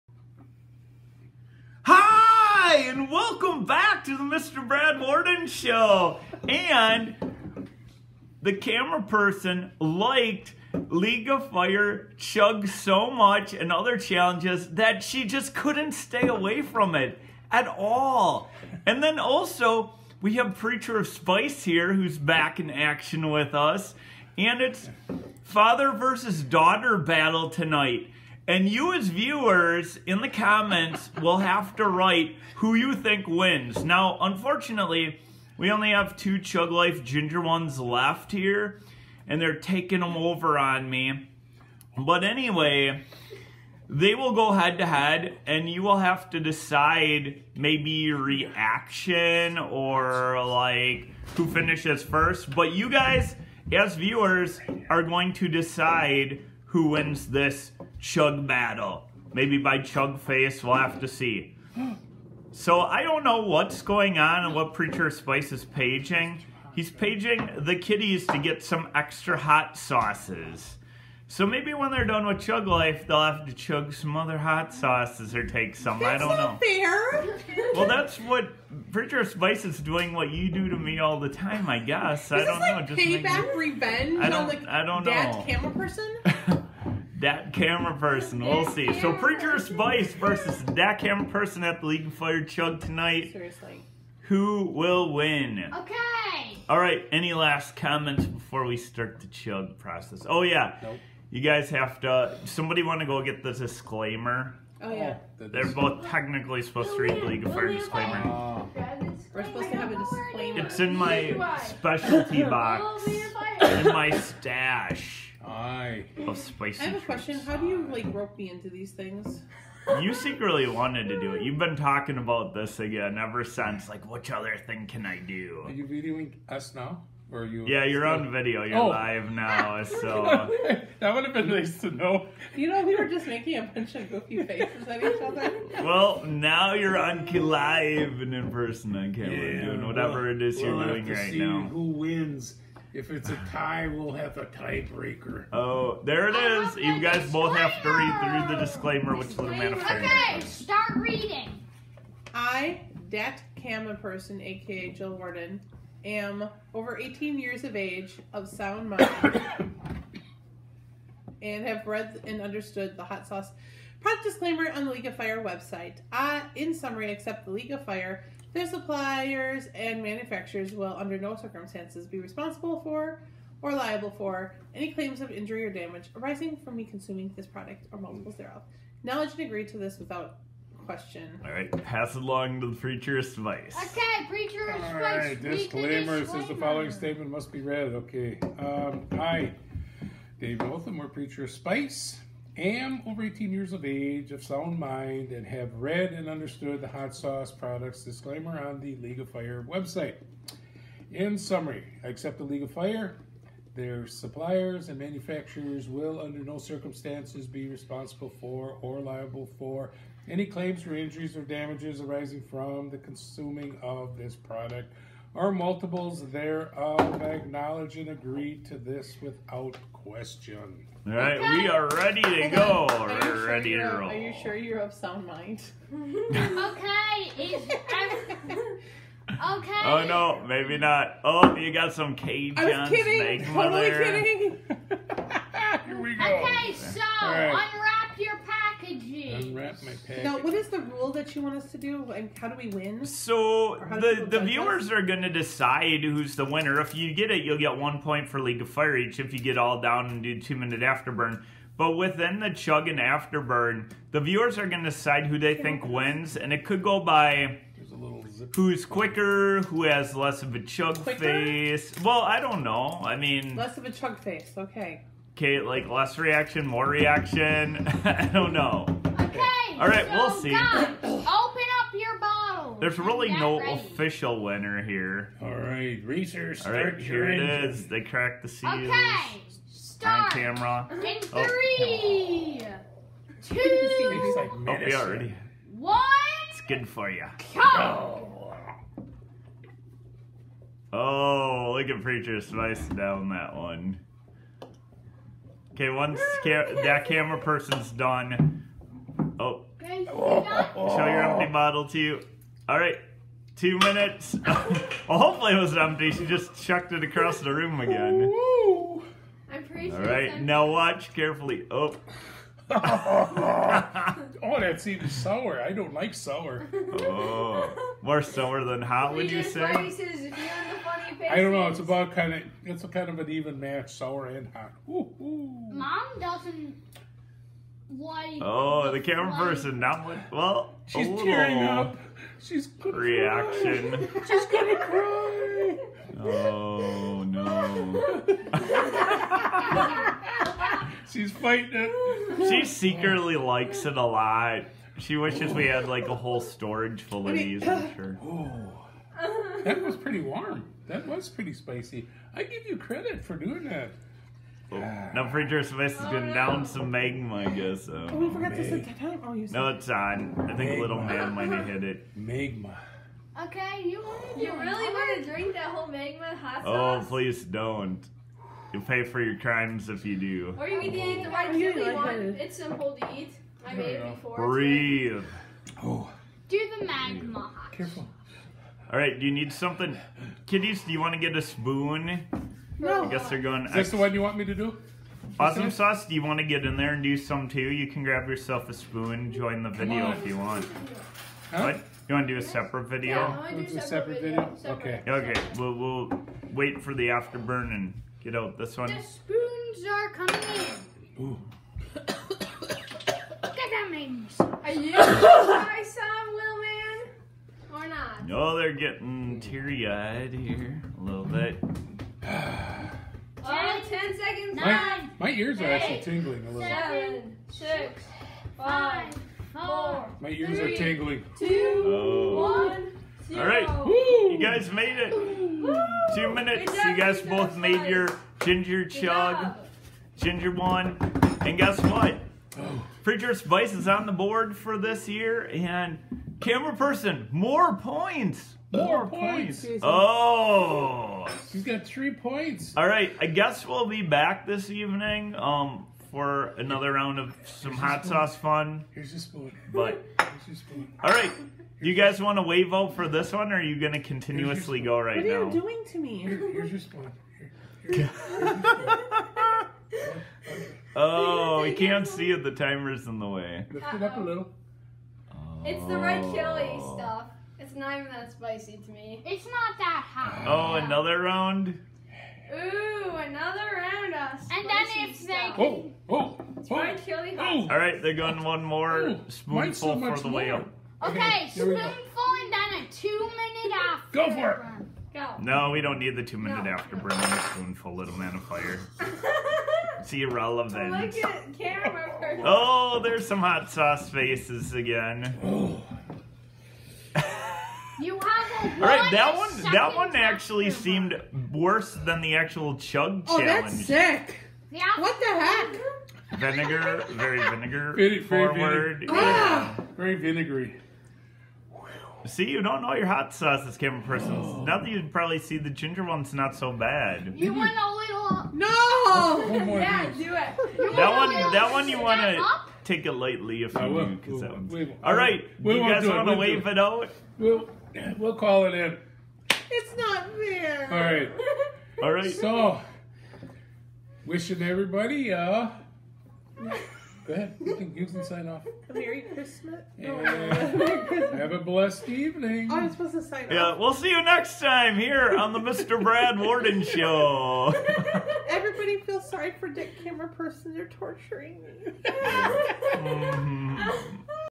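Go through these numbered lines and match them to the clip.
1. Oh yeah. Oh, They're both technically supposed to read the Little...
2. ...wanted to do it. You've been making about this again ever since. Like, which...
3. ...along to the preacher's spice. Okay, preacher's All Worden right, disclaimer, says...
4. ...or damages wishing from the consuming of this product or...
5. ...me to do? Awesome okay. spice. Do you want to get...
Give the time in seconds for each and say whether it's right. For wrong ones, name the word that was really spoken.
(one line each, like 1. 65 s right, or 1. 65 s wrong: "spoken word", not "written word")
1. 104 s wrong: "League", not "Little"
2. 120 s wrong: "talking", not "making"
3. 182 s wrong: "All", not "Worden"
4. 211 s wrong: "arising", not "wishing"
5. 384 s wrong: "sauce", not "spice".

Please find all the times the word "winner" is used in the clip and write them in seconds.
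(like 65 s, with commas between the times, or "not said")
246 s, 274 s.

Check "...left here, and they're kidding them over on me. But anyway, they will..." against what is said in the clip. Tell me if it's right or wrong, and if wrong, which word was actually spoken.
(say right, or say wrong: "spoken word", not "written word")
wrong: "taking", not "kidding".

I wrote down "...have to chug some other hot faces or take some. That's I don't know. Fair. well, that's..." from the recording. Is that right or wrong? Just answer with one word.
wrong.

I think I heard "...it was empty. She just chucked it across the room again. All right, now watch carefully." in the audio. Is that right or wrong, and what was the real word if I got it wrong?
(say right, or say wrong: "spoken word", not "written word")
right.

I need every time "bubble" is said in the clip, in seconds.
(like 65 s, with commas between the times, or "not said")
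not said.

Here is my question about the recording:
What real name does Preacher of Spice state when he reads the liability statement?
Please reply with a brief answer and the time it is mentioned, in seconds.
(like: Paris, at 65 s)
Dave Otham, at 190 s.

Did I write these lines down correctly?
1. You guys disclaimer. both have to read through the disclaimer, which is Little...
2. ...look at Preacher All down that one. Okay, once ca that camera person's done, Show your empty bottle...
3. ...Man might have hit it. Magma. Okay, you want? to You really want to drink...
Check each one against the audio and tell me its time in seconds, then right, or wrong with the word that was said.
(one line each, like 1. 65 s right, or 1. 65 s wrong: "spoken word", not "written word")
1. 146 s right
2. 291 s wrong: "Spice", not "All"
3. 361 s right.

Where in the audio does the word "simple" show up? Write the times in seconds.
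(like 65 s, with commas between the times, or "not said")
372 s.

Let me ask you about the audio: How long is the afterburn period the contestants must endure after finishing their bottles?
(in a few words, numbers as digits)
2 minutes.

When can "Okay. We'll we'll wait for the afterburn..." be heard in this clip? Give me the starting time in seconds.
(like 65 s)
395 s.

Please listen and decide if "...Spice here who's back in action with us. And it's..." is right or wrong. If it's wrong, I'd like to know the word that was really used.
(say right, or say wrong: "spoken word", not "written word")
right.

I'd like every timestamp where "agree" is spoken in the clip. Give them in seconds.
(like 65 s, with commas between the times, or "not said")
179 s, 218 s.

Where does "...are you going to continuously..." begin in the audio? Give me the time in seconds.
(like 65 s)
453 s.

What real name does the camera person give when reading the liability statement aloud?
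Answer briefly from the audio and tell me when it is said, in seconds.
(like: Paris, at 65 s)
Jill Worden, at 154 s.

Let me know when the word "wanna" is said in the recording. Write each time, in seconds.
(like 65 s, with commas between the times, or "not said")
522 s.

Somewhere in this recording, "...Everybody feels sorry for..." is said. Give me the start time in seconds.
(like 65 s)
548 s.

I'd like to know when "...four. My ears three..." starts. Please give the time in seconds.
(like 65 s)
419 s.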